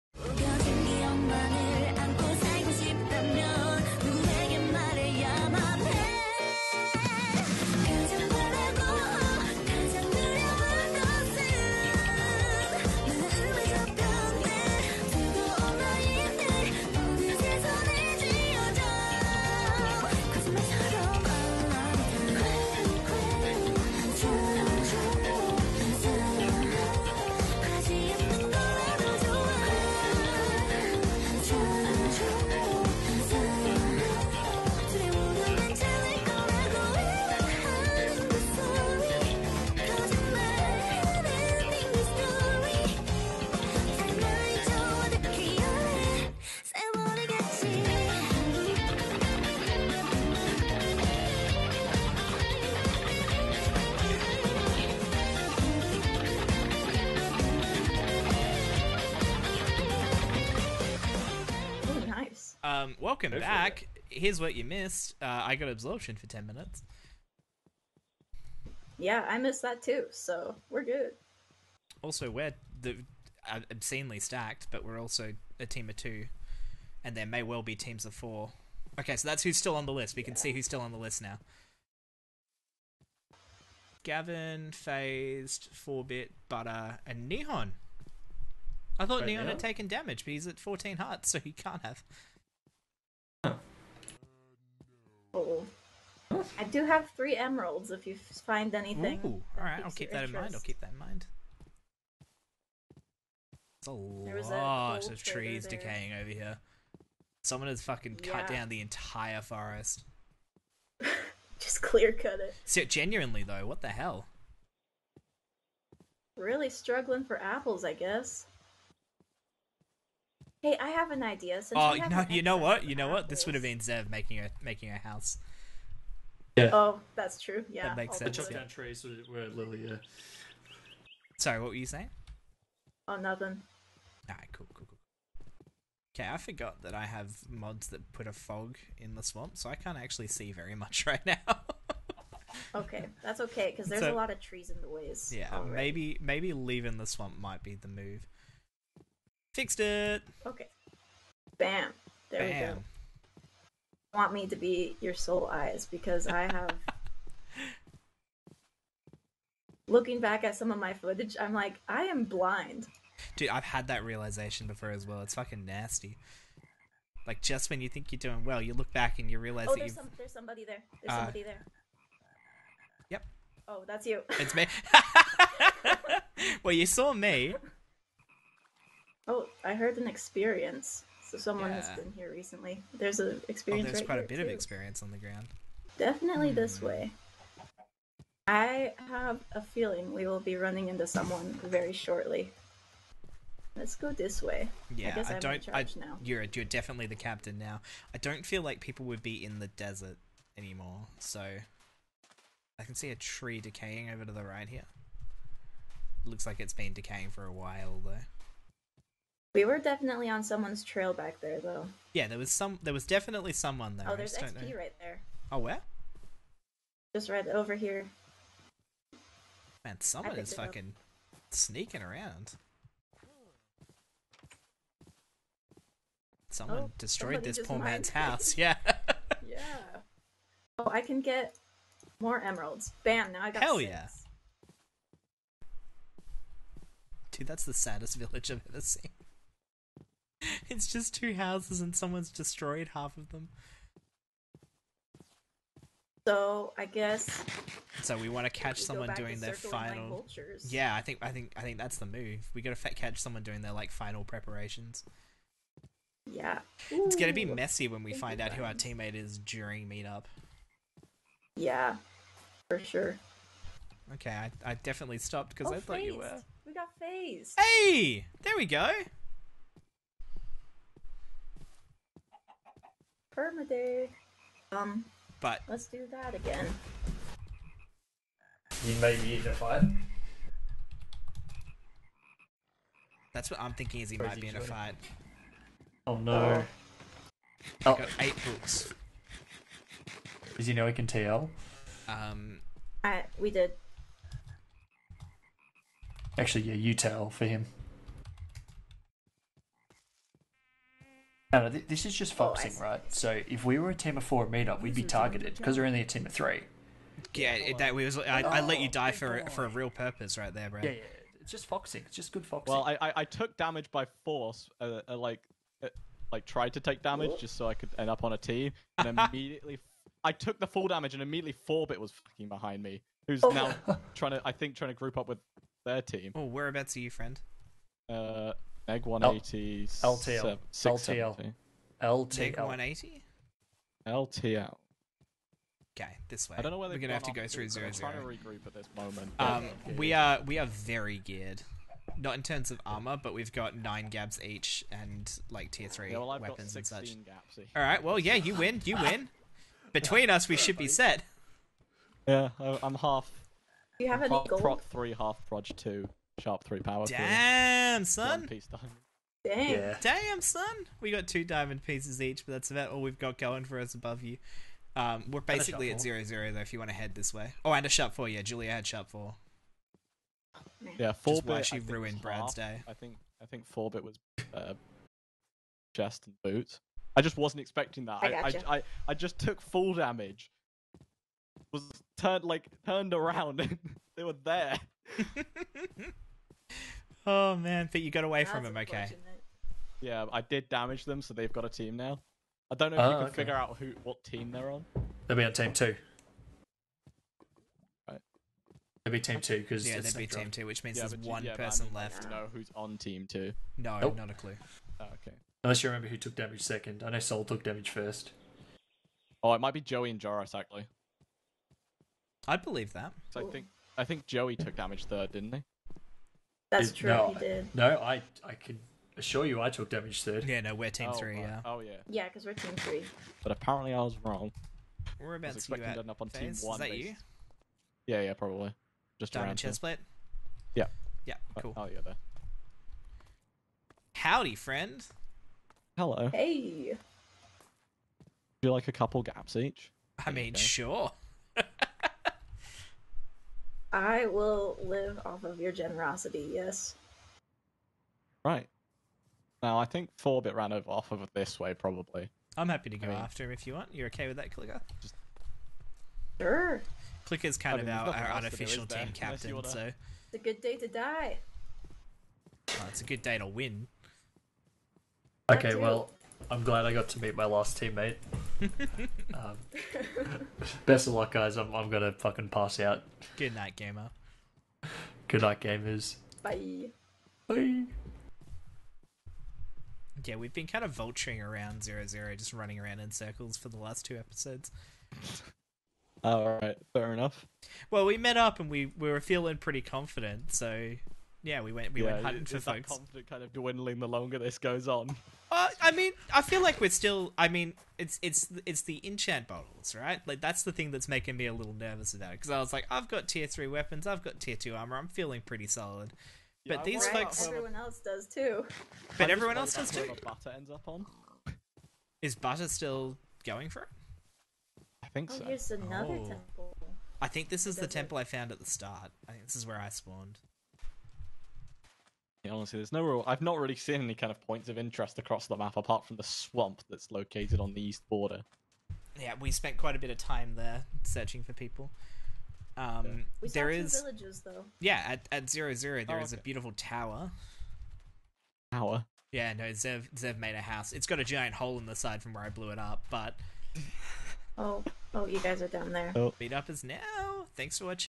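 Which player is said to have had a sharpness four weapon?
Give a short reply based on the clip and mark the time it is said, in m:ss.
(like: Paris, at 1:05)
Julia, at 6:08.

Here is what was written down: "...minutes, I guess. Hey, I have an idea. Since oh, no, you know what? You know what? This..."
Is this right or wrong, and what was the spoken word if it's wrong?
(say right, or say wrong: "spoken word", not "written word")
wrong: "apples", not "minutes".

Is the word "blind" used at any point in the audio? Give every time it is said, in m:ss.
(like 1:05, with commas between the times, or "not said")
2:42.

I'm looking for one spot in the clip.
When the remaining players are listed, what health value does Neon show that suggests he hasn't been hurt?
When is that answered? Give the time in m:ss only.
1:30.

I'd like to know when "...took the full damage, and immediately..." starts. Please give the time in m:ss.
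5:20.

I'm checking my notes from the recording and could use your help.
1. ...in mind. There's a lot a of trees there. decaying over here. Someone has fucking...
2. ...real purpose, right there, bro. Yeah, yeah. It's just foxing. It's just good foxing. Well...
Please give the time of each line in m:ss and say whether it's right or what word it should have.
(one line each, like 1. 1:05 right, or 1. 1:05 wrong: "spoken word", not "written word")
1. 1:40 right
2. 5:09 right.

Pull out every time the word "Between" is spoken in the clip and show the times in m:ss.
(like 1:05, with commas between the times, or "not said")
5:49.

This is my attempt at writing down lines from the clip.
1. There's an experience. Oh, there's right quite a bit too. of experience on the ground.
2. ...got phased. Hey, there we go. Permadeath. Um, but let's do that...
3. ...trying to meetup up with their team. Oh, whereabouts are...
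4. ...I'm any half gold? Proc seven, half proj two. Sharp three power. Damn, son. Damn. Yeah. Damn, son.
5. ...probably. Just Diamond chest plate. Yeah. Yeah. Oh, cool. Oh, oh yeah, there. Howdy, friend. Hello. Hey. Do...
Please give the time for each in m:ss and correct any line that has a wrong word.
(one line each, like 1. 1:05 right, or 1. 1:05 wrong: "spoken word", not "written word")
1. 3:02 right
2. 4:26 right
3. 5:24 wrong: "group", not "meetup"
4. 5:54 wrong: "three", not "seven"
5. 7:08 right.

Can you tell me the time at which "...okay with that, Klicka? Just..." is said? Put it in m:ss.
7:34.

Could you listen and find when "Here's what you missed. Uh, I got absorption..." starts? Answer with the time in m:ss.
1:04.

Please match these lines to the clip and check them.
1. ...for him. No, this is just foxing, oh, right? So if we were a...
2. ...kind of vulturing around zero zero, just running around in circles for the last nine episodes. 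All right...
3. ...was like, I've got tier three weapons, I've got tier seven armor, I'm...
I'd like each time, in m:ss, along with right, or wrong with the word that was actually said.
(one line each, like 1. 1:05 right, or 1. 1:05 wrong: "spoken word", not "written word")
1. 4:57 right
2. 8:00 wrong: "two", not "nine"
3. 8:22 wrong: "two", not "seven".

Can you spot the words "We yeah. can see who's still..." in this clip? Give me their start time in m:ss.
1:20.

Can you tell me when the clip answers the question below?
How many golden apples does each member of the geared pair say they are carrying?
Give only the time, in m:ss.
5:43.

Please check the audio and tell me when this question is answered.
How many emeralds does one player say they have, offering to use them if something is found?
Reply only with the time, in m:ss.
1:37.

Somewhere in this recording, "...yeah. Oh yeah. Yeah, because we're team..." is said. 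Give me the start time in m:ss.
7:01.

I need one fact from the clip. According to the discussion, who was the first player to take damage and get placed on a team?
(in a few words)
Sol.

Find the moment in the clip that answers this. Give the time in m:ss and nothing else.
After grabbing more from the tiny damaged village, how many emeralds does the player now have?
3:53.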